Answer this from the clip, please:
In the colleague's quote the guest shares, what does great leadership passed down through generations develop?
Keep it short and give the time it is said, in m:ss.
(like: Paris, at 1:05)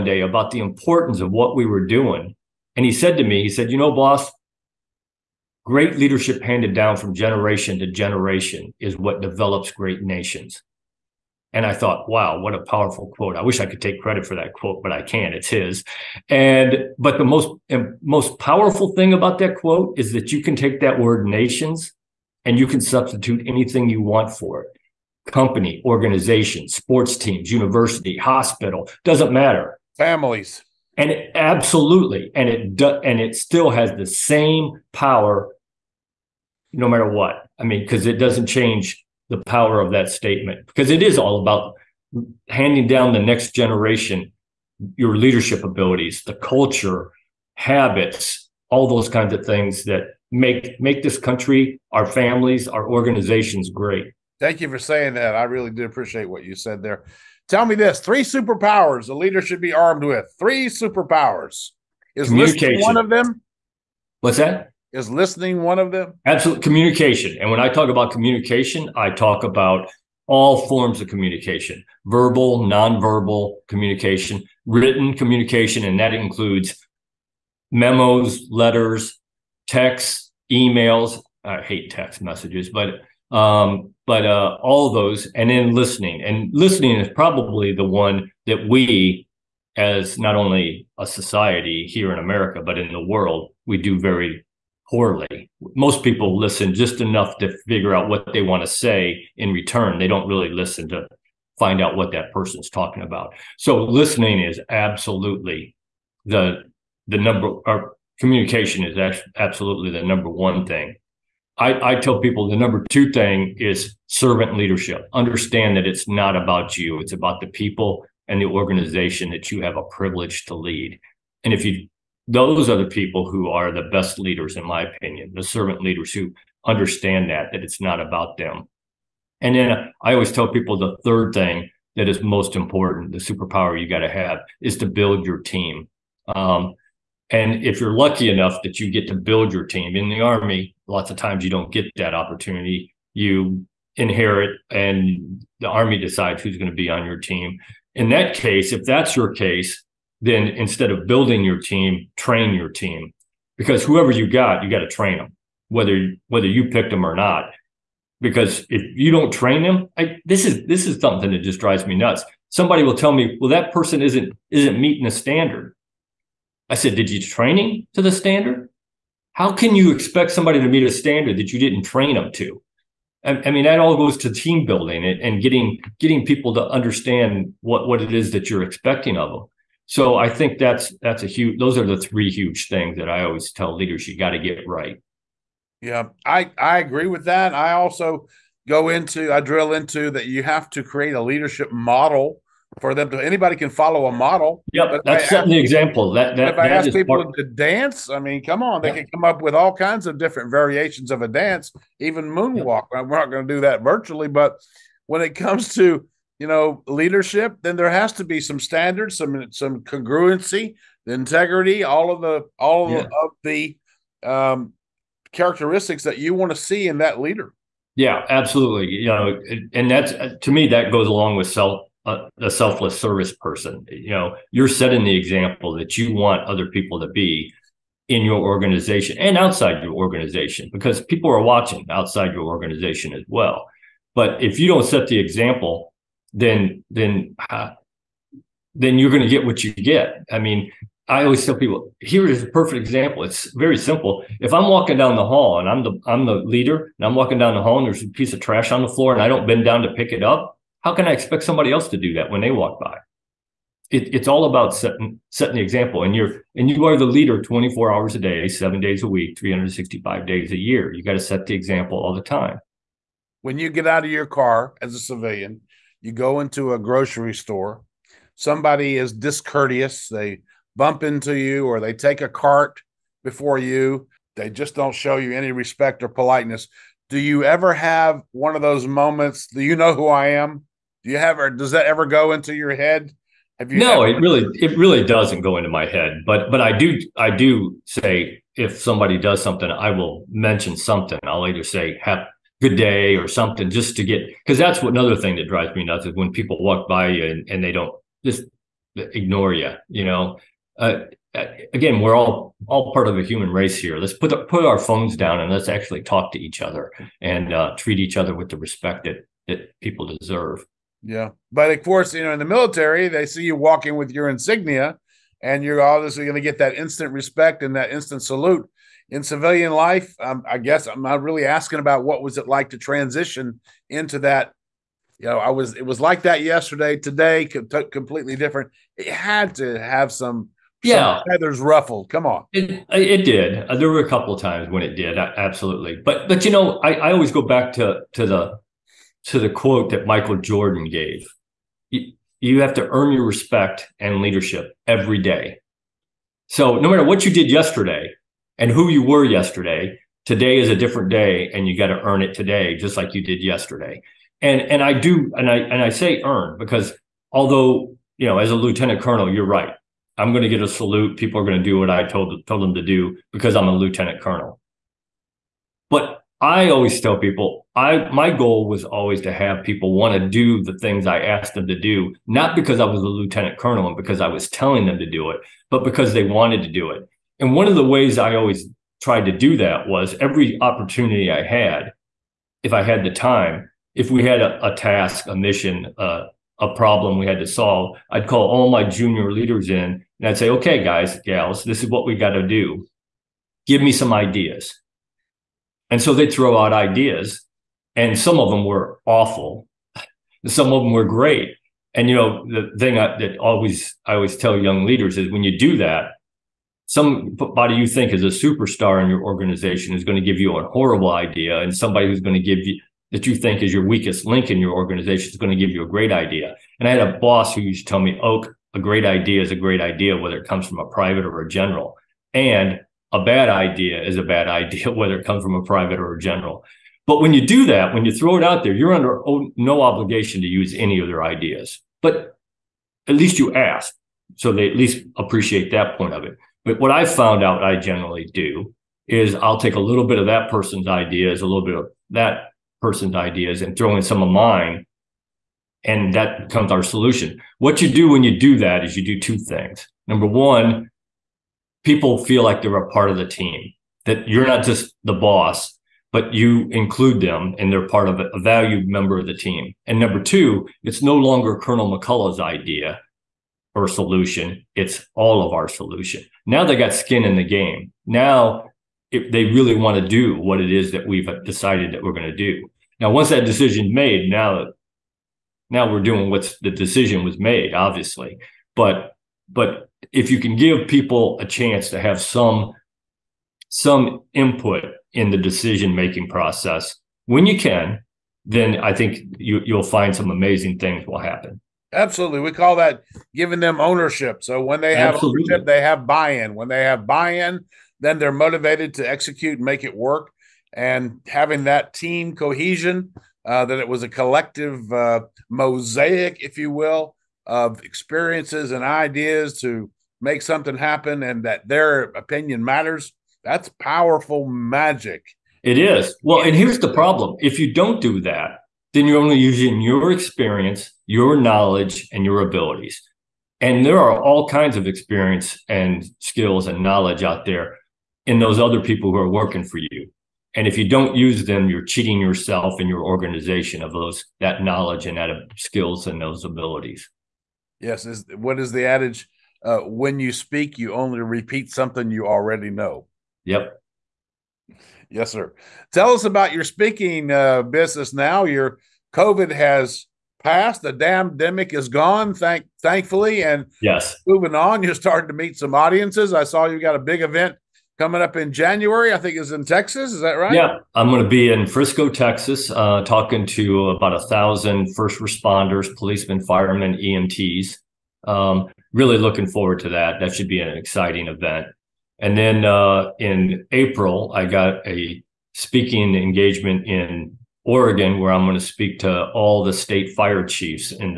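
great nations, at 0:09.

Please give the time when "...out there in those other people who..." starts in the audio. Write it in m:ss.
8:47.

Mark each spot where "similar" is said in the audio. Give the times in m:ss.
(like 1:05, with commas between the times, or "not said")
not said.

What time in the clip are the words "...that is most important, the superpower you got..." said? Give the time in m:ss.
2:11.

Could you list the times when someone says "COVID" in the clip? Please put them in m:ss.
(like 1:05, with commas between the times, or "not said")
9:09.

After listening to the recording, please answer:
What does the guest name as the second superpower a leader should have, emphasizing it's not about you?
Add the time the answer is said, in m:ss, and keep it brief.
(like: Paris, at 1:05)
servant leadership, at 1:54.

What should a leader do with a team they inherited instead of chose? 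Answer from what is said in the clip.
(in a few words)
train your team.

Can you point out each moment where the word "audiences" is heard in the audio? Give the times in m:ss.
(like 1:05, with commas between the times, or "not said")
9:15.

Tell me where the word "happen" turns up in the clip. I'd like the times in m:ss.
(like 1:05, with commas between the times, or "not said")
8:11, 8:30.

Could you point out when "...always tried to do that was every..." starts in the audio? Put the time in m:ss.
6:18.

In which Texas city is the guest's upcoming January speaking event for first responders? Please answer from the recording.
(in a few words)
Frisco.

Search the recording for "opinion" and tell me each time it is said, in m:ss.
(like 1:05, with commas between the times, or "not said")
2:04, 8:32.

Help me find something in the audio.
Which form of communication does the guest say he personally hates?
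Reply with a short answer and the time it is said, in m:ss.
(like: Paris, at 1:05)
text messages, at 1:21.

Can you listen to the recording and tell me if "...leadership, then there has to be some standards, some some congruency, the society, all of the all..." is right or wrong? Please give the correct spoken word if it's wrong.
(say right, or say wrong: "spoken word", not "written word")
wrong: "integrity", not "society".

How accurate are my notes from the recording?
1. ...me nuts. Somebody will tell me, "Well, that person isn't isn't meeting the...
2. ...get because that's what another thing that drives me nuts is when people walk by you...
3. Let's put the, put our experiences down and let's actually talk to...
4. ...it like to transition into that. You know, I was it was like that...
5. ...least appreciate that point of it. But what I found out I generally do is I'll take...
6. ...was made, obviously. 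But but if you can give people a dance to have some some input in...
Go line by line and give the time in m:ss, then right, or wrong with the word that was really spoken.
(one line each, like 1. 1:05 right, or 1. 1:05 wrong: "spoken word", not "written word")
1. 2:41 right
2. 4:54 right
3. 5:03 wrong: "phones", not "experiences"
4. 5:22 right
5. 7:14 right
6. 7:57 wrong: "chance", not "dance".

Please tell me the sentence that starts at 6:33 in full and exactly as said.
Give me some ideas and so they'd throw out ideas, and some of them were awful, some of them were great.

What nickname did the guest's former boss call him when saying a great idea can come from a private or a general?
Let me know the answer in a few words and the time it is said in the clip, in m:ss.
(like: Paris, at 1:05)
Oak, at 6:58.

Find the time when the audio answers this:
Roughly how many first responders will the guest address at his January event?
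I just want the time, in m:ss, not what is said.
9:24.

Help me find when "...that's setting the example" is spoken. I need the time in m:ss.
3:15.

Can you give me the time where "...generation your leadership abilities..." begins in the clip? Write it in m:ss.
0:43.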